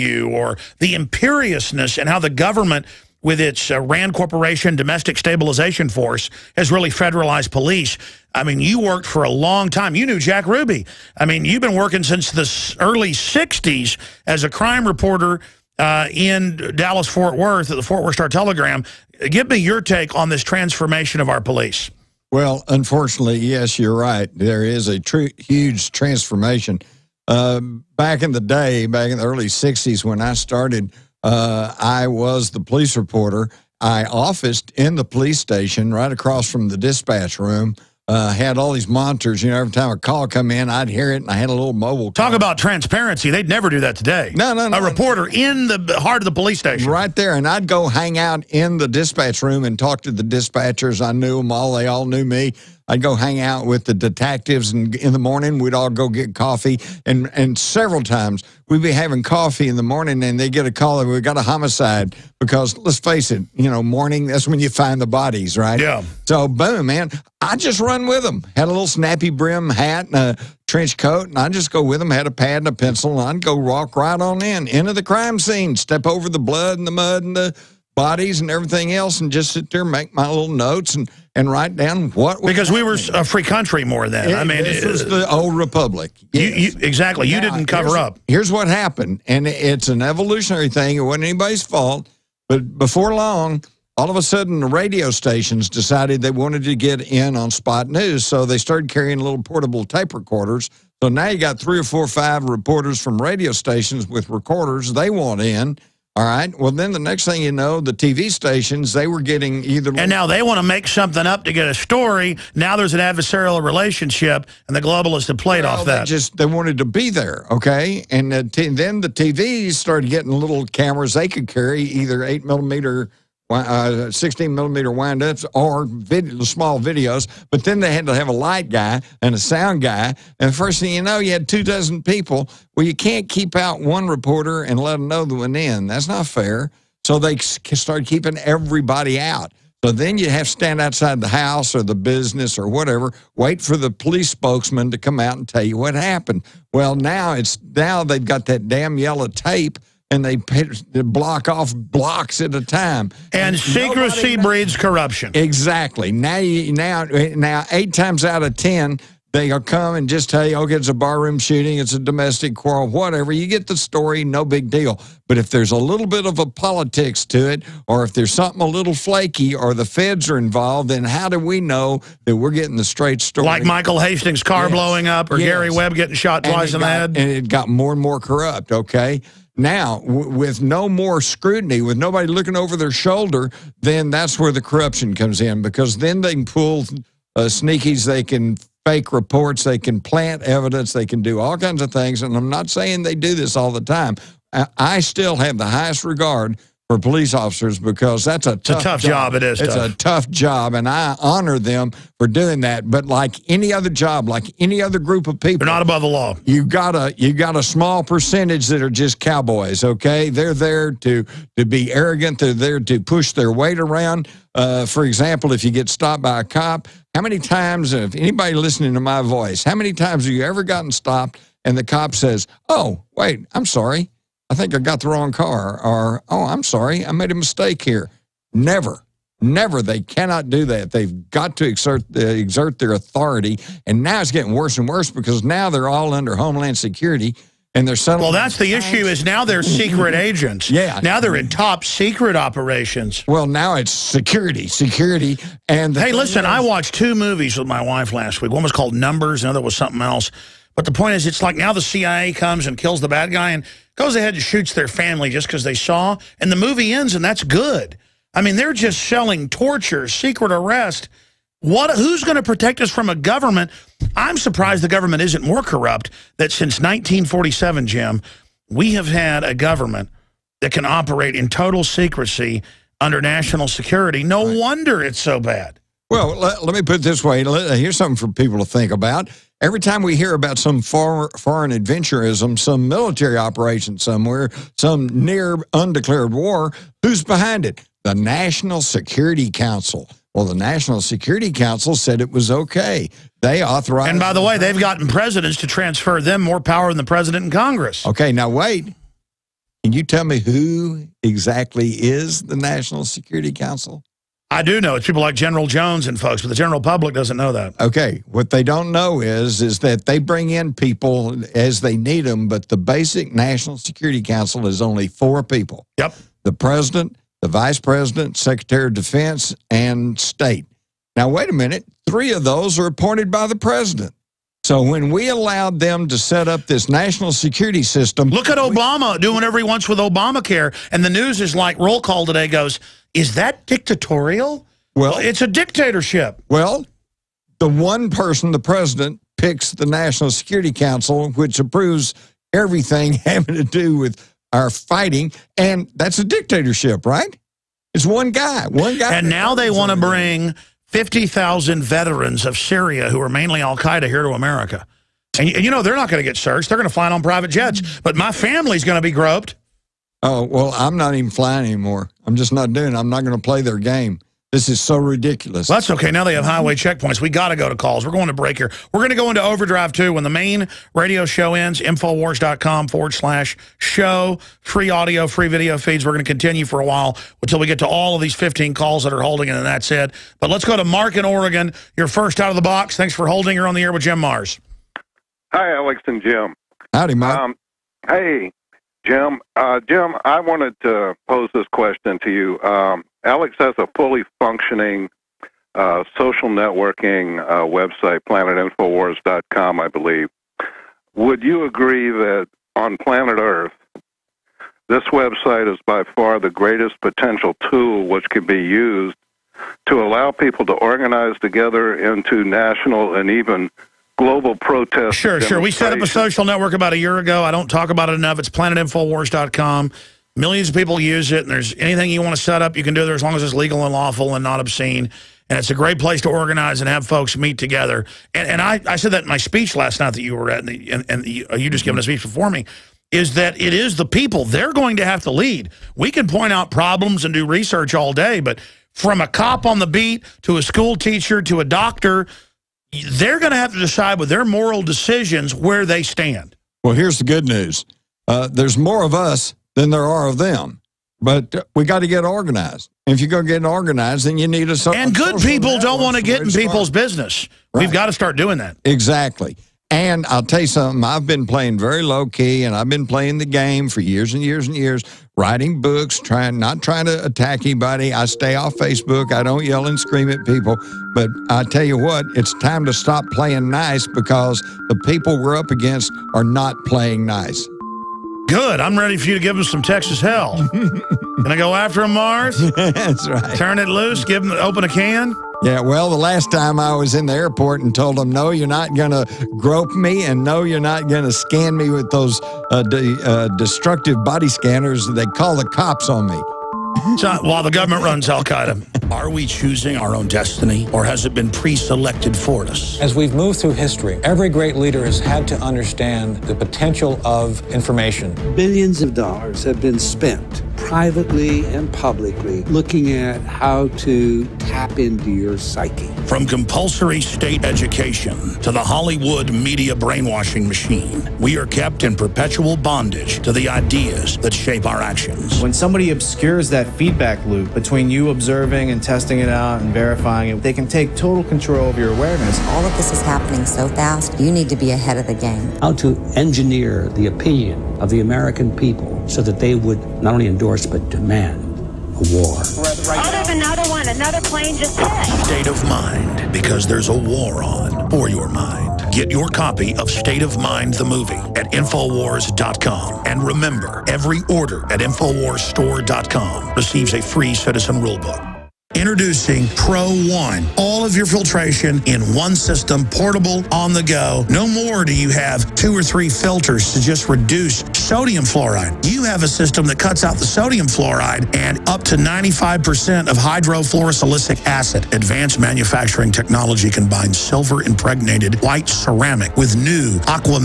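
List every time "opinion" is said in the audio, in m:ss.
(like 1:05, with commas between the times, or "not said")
8:57.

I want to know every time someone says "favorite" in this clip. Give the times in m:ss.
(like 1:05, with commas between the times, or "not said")
not said.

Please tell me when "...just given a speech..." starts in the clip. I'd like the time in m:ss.
7:11.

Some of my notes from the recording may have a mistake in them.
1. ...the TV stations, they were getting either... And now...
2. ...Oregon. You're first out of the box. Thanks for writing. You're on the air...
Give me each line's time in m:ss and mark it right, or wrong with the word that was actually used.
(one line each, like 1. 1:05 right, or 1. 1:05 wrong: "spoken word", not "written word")
1. 1:47 right
2. 6:21 wrong: "holding", not "writing".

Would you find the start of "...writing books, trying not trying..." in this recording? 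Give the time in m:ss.
7:45.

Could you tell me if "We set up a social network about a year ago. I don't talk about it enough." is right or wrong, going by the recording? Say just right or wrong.
right.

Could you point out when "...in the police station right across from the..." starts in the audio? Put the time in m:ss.
0:34.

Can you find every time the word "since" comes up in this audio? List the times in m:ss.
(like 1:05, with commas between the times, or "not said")
0:12, 4:26.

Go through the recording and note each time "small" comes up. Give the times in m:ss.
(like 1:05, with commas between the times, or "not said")
2:06, 3:27.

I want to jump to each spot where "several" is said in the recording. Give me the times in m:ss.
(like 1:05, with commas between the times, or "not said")
0:57.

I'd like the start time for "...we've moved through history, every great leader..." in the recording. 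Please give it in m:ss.
8:23.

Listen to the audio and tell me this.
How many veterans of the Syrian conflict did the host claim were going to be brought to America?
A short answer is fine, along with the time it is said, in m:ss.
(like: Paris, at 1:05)
50,000, at 5:50.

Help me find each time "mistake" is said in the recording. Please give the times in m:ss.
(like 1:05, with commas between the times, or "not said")
3:47.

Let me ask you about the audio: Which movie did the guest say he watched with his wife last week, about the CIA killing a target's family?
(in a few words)
Numbers.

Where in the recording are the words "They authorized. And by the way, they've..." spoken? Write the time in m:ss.
4:53.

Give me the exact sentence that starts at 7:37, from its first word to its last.
We've got to start doing that.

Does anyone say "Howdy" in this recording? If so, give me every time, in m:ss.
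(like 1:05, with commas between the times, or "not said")
6:26.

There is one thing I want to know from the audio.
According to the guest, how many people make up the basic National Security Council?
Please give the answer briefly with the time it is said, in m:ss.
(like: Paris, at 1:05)
4, at 5:15.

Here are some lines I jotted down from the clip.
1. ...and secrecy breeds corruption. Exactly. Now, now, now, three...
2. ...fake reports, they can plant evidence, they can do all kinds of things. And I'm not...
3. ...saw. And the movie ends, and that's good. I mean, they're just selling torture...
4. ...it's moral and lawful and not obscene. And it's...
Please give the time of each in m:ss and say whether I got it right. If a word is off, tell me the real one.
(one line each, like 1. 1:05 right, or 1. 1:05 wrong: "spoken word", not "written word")
1. 2:33 wrong: "eight", not "three"
2. 3:08 right
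3. 4:15 right
4. 7:03 wrong: "legal", not "moral".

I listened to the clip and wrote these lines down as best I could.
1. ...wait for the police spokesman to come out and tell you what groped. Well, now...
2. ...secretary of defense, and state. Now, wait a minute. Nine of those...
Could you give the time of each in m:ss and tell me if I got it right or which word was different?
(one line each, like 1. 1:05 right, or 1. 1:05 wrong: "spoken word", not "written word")
1. 2:23 wrong: "happened", not "groped"
2. 5:18 wrong: "Three", not "Nine".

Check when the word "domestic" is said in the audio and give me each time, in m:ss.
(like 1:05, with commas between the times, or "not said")
0:04, 2:41.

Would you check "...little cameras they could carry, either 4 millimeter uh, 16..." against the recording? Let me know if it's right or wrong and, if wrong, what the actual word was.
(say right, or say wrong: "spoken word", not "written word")
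wrong: "8", not "4".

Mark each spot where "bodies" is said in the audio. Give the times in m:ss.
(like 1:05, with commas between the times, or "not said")
1:05, 1:17.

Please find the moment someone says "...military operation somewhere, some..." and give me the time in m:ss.
4:42.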